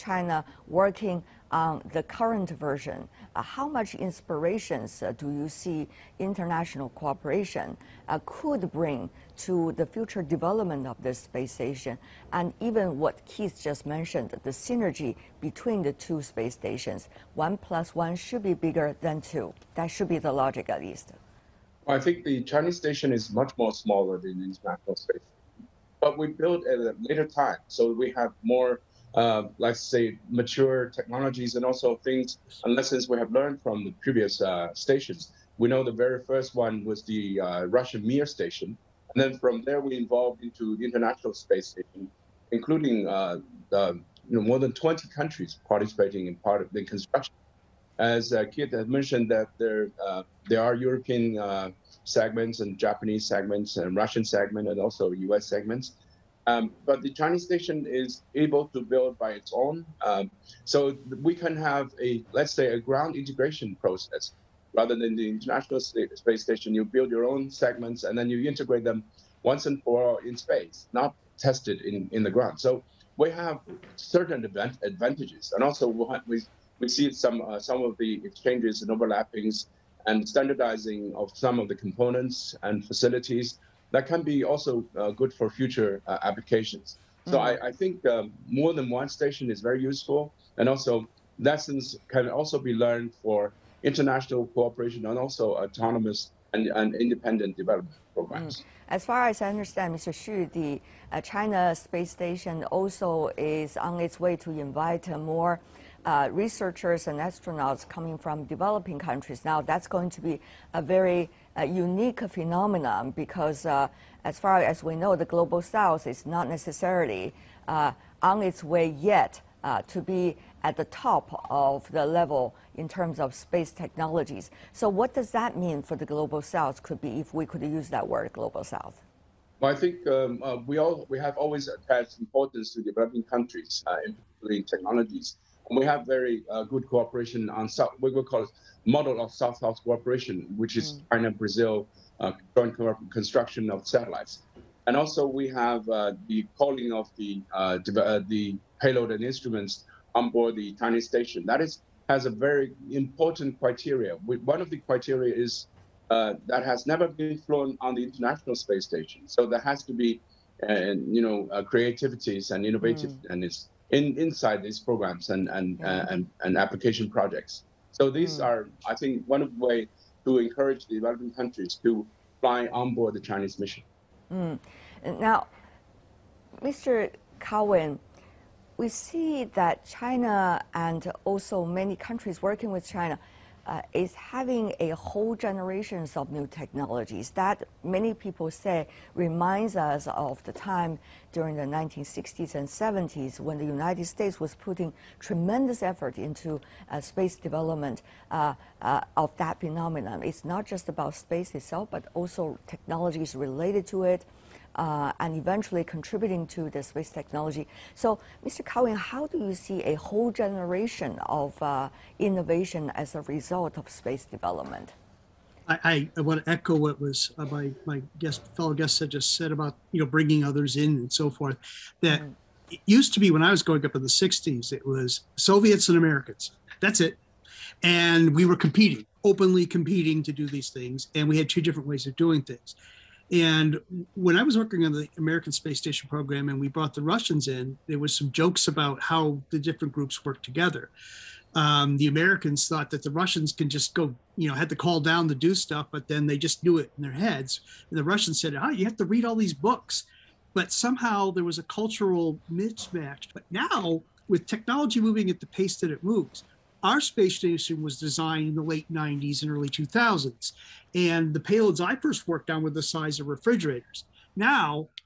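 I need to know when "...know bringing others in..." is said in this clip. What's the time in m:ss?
3:40.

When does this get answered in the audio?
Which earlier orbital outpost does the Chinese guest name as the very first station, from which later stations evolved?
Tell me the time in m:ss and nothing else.
0:37.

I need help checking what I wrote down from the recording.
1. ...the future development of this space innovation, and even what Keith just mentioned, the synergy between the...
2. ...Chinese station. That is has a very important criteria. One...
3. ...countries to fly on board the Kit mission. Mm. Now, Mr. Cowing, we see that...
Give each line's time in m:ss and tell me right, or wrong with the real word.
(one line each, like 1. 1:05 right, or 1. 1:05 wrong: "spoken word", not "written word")
1. 0:09 wrong: "station", not "innovation"
2. 2:30 right
3. 2:51 wrong: "Chinese", not "Kit".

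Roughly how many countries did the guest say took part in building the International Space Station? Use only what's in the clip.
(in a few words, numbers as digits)
more than 20.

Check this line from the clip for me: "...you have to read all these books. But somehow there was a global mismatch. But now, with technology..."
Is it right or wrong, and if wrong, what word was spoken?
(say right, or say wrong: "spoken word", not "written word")
wrong: "cultural", not "global".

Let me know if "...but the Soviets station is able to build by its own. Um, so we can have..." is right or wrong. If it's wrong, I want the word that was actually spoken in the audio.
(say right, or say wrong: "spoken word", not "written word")
wrong: "Chinese", not "Soviets".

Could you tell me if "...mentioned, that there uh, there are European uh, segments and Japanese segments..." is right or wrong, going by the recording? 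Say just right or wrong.
right.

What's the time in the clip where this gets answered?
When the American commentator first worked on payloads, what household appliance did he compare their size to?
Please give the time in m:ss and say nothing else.
4:23.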